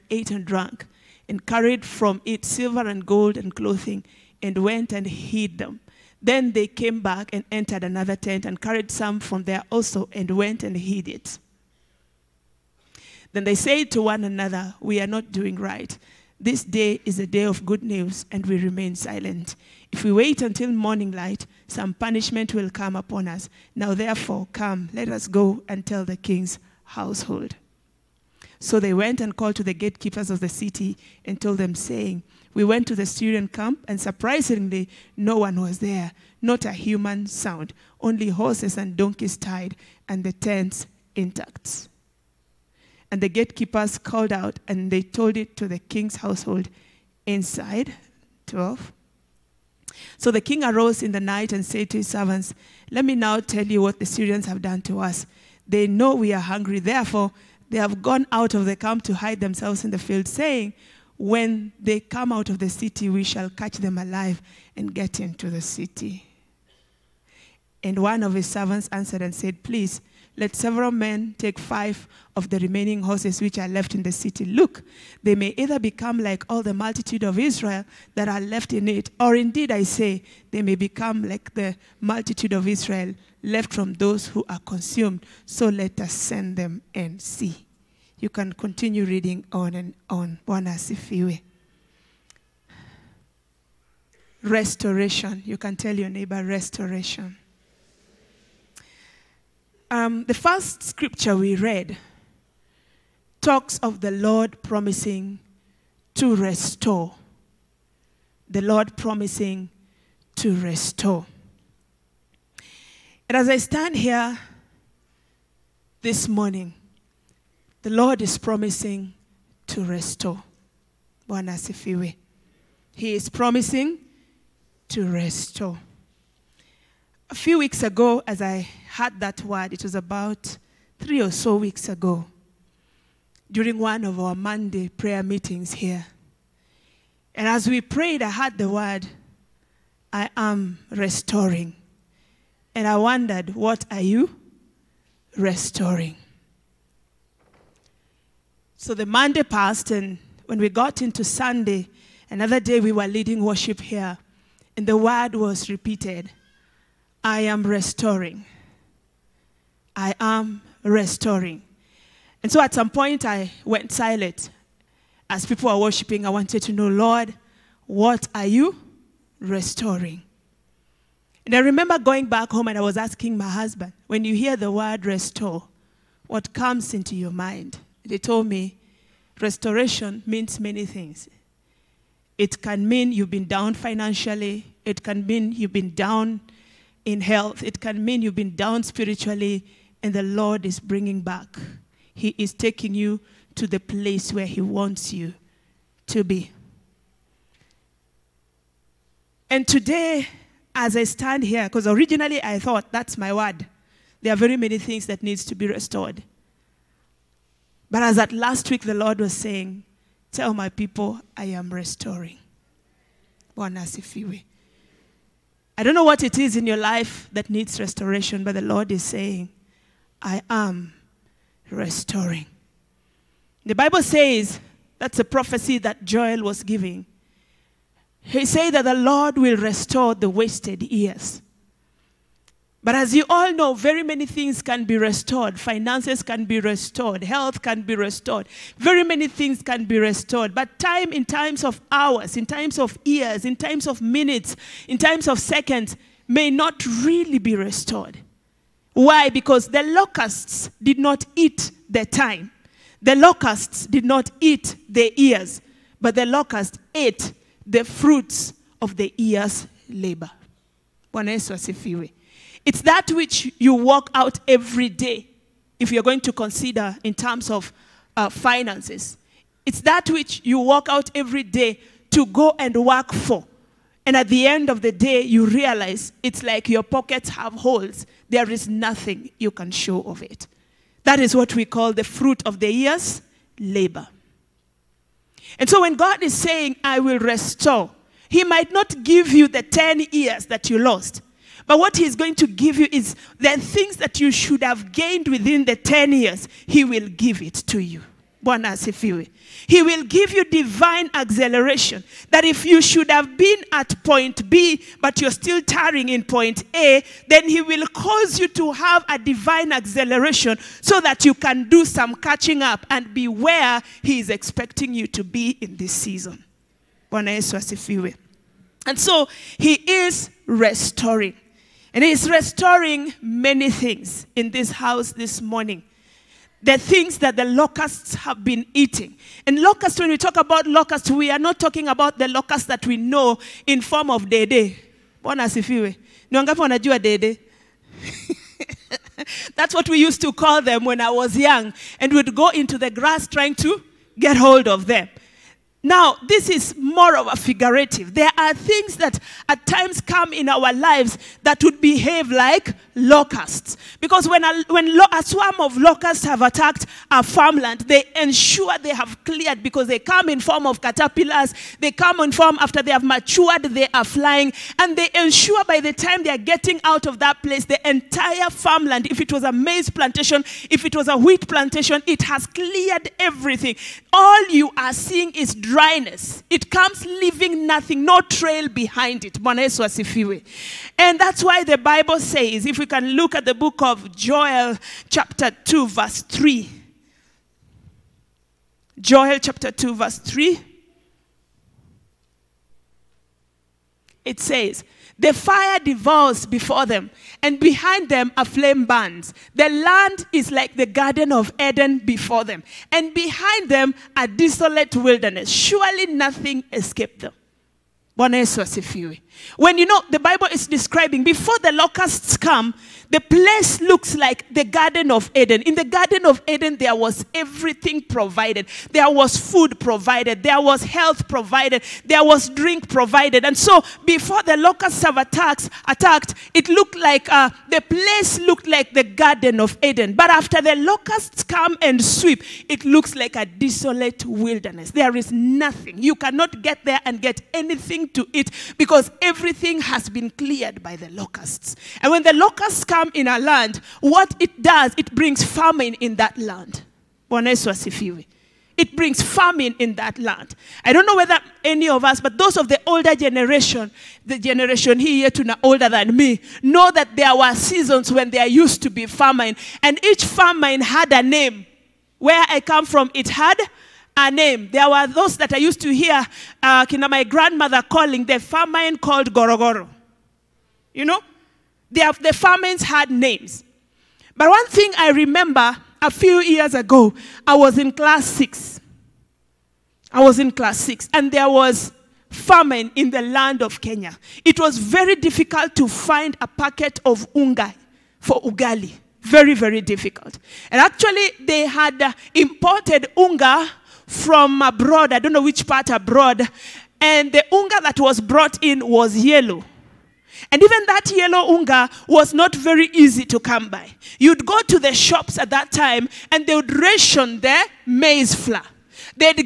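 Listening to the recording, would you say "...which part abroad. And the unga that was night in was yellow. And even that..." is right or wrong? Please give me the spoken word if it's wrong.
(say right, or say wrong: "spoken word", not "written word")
wrong: "brought", not "night".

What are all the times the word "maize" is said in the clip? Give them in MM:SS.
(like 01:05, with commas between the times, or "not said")
06:09, 08:27.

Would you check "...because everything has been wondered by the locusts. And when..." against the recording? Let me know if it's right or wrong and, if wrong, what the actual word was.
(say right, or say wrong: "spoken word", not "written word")
wrong: "cleared", not "wondered".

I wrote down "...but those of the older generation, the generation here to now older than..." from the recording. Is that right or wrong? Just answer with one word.
right.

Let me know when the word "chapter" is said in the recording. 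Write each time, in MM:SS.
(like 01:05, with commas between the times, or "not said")
06:25, 06:29.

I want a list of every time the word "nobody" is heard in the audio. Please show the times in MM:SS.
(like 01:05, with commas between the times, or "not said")
not said.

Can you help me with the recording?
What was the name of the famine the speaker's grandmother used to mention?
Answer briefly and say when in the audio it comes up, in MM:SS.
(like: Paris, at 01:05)
Gorogoro, at 07:49.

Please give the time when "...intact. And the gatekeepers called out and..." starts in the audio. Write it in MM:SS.
00:41.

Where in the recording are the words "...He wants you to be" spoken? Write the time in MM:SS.
03:14.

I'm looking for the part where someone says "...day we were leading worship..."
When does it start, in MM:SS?
02:32.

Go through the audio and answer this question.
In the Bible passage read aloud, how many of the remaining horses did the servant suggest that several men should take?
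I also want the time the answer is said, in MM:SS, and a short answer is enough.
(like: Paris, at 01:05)
5, at 01:11.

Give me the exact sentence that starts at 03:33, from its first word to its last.
Bwana I don't know what it is in your life that needs restoration, but the Lord is saying, I am restoring.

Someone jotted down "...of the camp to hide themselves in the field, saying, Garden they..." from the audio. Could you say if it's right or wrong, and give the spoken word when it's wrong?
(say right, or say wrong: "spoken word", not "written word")
wrong: "When", not "Garden".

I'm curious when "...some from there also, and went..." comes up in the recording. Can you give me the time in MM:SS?
00:08.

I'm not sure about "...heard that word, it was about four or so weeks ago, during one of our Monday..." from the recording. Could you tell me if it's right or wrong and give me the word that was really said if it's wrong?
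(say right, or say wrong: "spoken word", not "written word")
wrong: "three", not "four".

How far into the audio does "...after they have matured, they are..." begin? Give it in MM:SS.
06:02.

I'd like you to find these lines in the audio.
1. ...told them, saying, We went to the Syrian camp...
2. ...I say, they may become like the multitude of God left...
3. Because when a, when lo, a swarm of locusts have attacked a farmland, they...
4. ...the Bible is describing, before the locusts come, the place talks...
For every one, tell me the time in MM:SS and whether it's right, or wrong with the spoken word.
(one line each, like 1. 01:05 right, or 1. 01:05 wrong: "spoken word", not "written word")
1. 00:31 right
2. 01:19 wrong: "Israel", not "God"
3. 05:53 right
4. 06:50 wrong: "looks", not "talks".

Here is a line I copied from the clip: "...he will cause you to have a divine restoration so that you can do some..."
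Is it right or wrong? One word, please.
wrong.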